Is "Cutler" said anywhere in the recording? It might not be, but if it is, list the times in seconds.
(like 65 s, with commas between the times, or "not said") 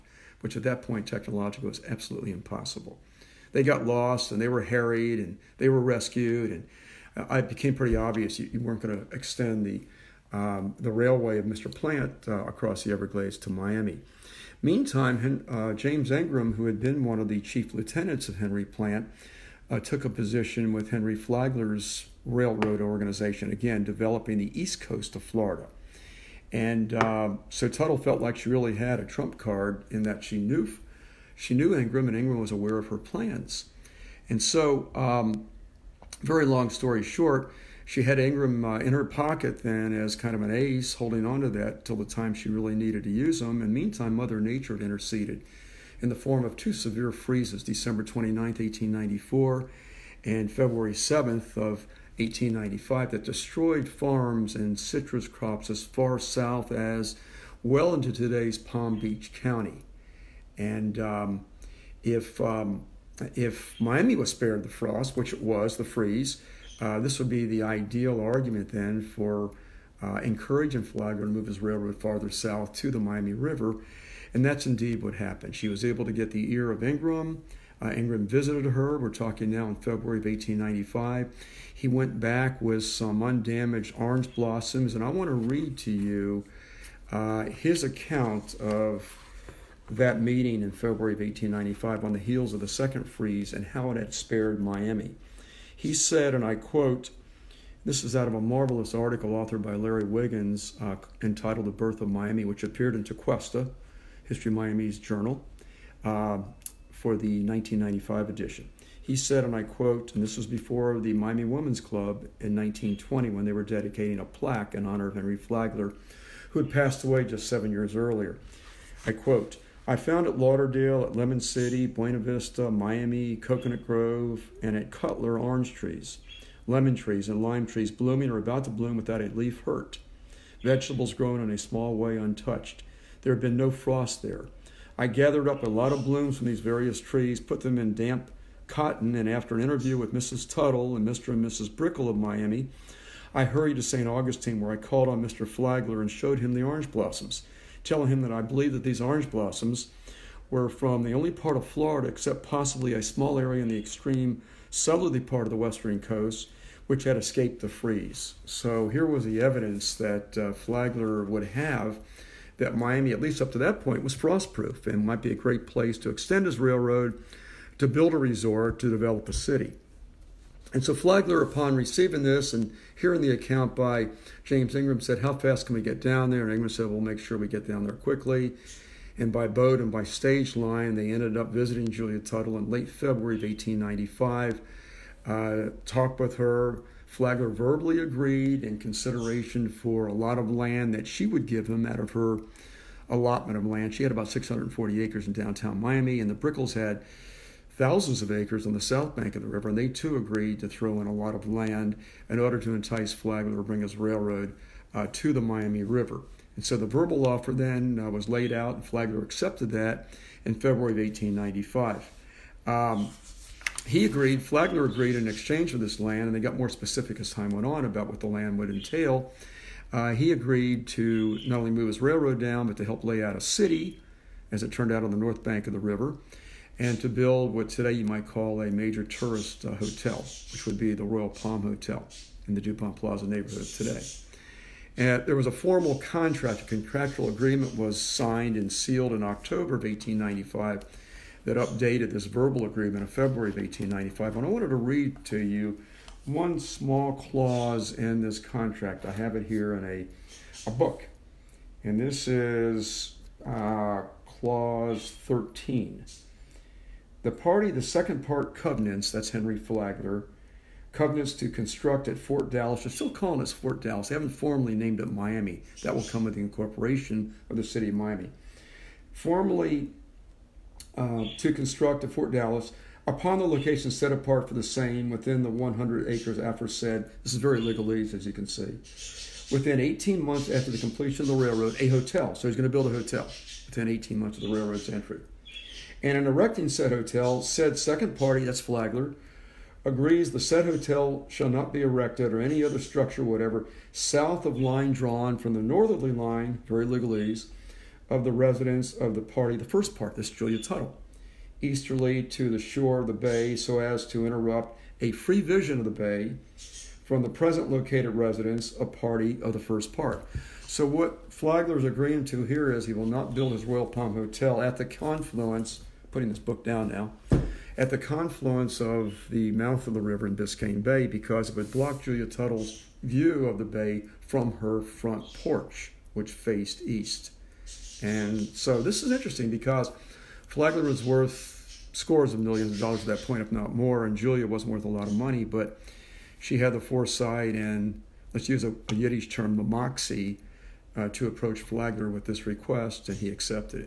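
124 s.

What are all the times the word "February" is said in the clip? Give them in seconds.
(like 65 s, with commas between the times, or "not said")
50 s, 79 s, 90 s, 182 s, 210 s, 243 s.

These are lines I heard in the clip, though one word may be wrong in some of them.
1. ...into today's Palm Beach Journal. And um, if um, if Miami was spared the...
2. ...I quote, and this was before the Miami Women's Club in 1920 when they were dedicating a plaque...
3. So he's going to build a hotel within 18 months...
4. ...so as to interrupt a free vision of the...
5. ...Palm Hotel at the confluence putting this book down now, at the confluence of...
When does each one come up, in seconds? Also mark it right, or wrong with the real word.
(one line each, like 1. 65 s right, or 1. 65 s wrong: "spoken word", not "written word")
1. 57 s wrong: "County", not "Journal"
2. 109 s right
3. 282 s right
4. 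303 s right
5. 313 s right.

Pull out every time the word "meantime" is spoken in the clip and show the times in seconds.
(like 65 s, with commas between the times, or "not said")
14 s, 43 s.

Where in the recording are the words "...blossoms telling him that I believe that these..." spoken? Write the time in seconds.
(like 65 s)
146 s.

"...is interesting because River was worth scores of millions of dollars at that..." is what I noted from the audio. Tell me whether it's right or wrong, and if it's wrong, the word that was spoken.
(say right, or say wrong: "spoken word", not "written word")
wrong: "Flagler", not "River".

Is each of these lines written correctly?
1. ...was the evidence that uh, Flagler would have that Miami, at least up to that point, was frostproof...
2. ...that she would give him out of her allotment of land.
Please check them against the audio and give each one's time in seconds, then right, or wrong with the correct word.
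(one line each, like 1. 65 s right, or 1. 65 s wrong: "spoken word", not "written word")
1. 159 s right
2. 190 s right.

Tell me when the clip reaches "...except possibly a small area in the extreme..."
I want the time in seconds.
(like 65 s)
152 s.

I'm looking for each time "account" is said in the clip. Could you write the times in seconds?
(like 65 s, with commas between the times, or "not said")
87 s, 173 s.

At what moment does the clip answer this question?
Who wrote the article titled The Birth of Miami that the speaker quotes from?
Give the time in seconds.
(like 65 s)
99 s.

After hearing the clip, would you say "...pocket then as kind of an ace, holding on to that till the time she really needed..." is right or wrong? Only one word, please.
right.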